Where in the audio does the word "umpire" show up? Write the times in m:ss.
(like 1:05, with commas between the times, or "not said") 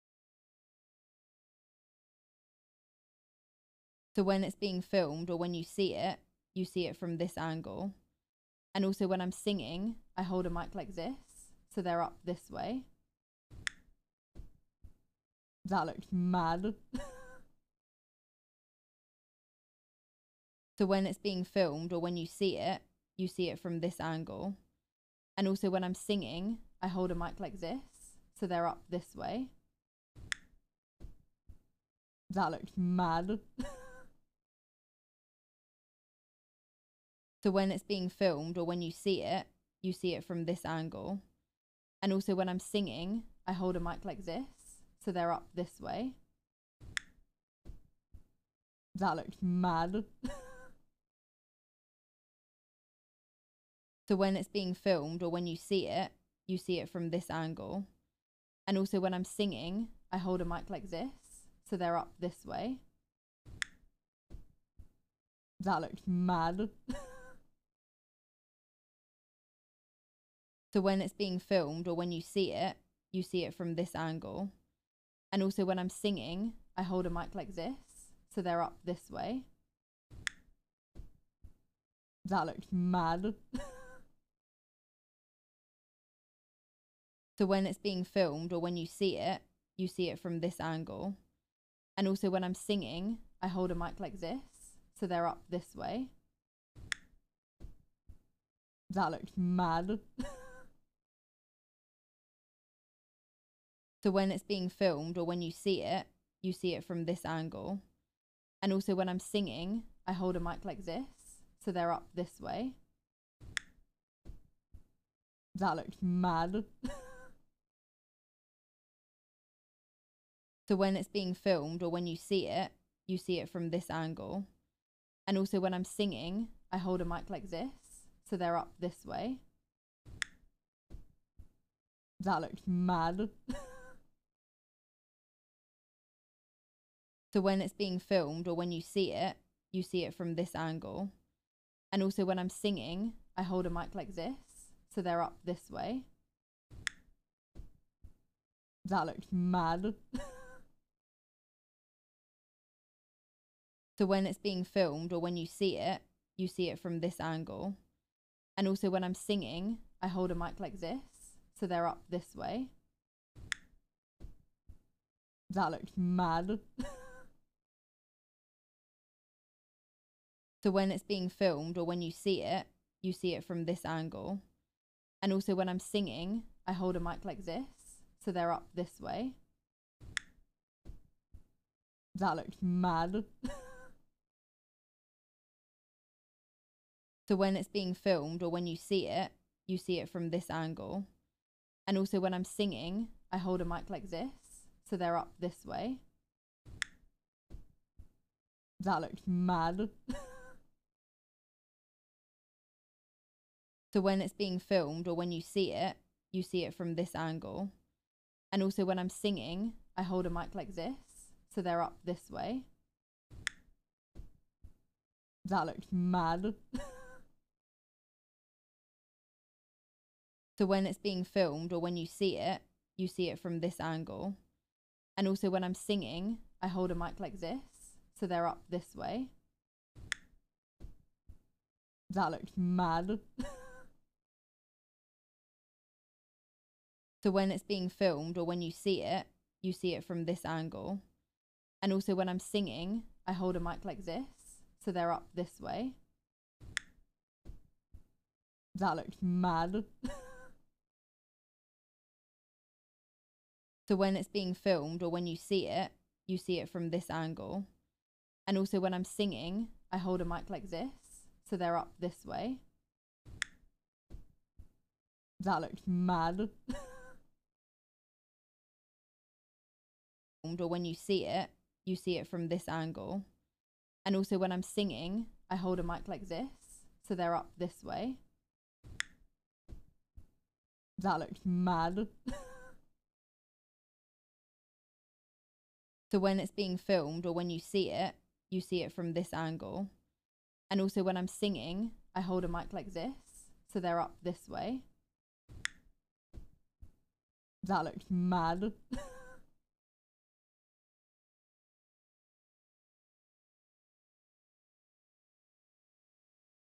not said.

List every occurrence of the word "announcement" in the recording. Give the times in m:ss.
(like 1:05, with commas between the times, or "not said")
not said.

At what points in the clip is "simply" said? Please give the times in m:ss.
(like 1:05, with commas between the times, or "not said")
not said.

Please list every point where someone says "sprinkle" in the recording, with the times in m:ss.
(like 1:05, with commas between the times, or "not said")
not said.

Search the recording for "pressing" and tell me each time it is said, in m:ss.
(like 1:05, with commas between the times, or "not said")
not said.